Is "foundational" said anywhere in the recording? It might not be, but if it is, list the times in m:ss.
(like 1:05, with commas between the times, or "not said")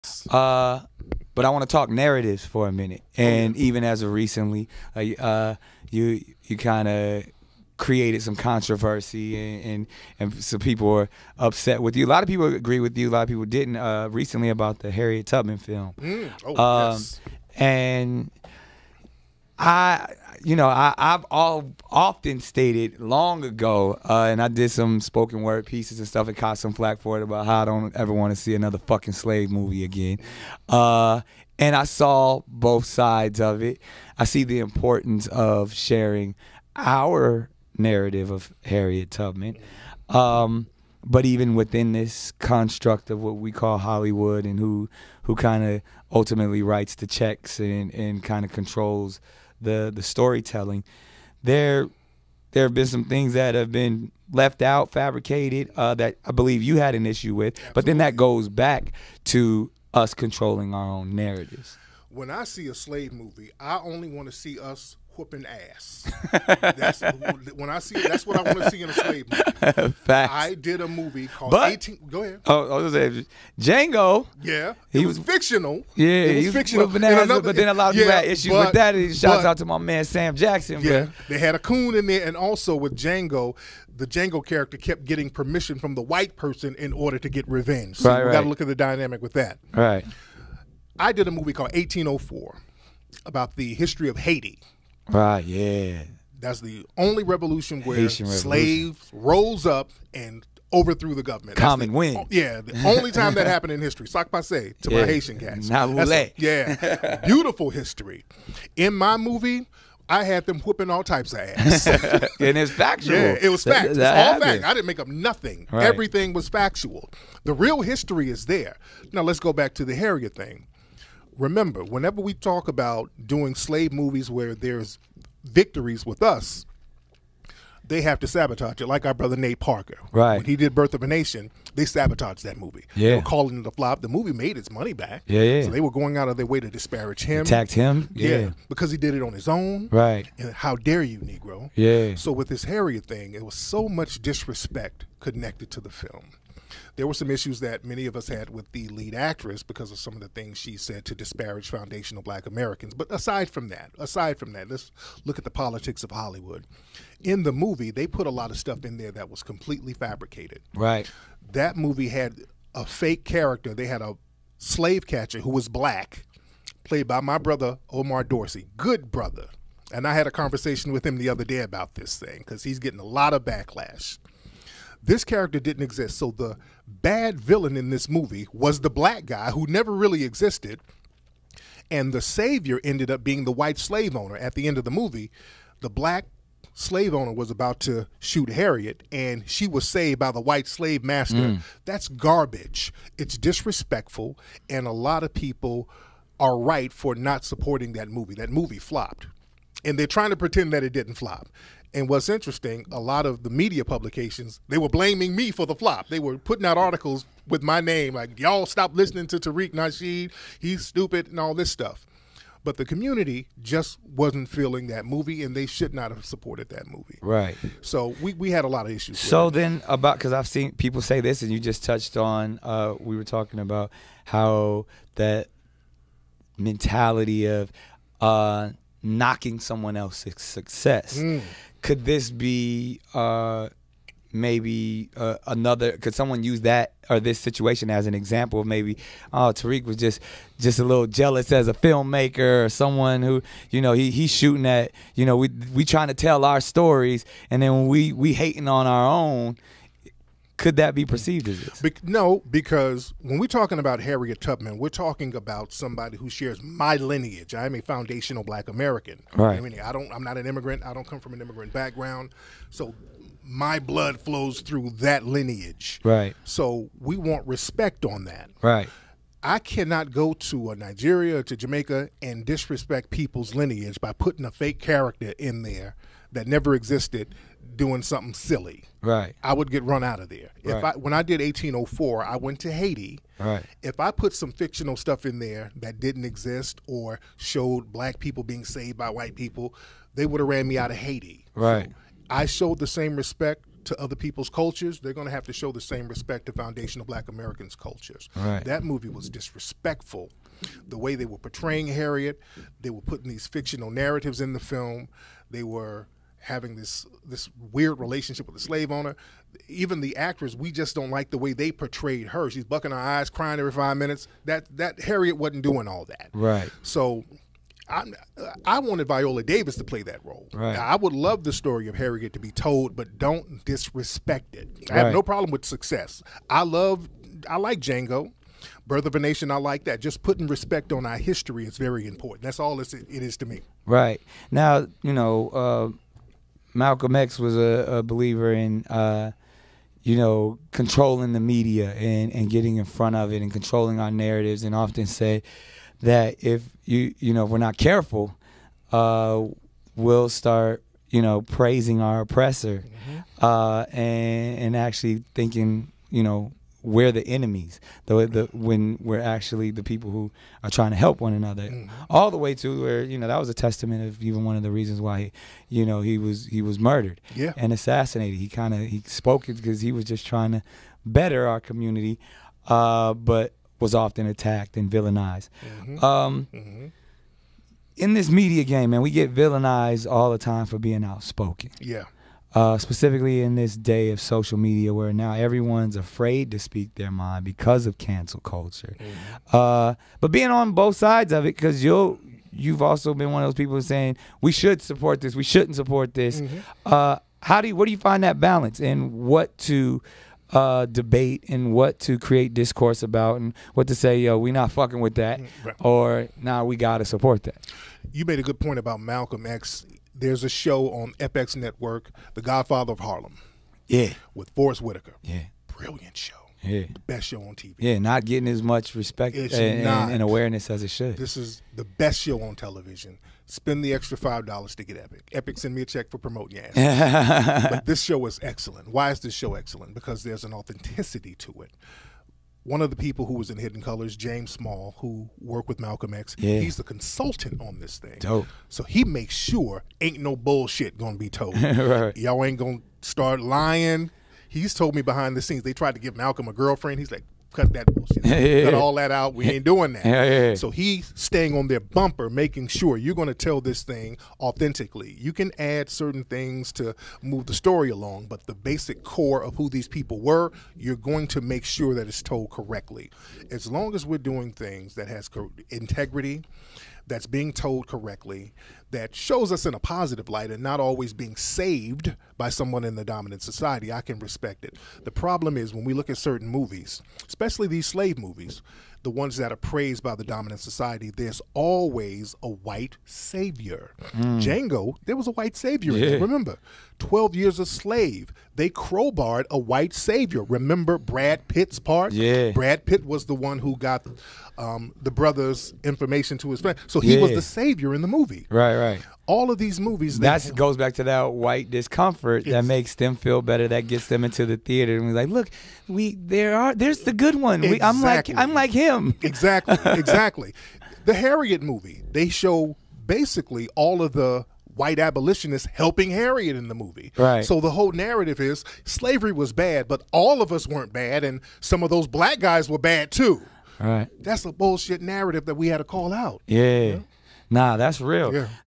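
2:31, 4:17, 4:56.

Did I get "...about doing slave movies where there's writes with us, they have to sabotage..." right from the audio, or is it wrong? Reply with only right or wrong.
wrong.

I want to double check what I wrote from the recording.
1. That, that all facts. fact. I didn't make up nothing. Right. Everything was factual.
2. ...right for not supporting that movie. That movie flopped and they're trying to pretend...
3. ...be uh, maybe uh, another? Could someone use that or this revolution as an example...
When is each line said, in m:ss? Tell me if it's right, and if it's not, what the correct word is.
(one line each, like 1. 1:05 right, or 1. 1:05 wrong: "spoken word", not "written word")
1. 1:53 right
2. 3:16 right
3. 3:52 wrong: "situation", not "revolution".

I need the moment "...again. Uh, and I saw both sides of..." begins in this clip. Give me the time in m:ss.
0:29.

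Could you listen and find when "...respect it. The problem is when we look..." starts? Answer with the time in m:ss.
7:54.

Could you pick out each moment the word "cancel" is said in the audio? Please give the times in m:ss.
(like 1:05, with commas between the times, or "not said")
6:27.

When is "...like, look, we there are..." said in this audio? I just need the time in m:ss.
8:25.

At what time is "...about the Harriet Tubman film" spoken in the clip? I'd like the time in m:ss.
0:14.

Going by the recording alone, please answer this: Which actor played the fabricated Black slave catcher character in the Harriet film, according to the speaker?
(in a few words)
Omar Dorsey.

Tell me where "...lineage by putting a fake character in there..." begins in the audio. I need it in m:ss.
4:33.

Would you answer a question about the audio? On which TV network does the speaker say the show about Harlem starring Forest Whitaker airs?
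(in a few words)
FX.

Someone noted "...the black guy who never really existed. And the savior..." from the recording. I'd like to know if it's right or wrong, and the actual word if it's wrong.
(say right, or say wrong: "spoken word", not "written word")
right.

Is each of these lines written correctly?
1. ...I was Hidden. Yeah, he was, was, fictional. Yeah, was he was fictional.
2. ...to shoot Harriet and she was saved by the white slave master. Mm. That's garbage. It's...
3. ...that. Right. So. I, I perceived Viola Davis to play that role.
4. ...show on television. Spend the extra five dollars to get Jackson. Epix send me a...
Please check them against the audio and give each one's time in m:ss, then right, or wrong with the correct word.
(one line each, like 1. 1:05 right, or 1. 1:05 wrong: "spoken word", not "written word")
1. 1:12 wrong: "Django", not "Hidden"
2. 3:07 right
3. 5:16 wrong: "wanted", not "perceived"
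4. 7:02 wrong: "Epix", not "Jackson".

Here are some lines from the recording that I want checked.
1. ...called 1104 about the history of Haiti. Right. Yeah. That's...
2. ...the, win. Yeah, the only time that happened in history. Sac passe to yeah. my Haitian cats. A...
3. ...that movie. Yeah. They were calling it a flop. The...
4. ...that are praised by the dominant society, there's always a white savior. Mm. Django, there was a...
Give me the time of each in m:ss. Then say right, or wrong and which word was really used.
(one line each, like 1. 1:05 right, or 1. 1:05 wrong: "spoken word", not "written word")
1. 1:31 wrong: "1804", not "1104"
2. 1:41 right
3. 2:12 right
4. 7:59 right.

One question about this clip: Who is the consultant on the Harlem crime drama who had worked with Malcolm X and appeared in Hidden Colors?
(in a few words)
James Small.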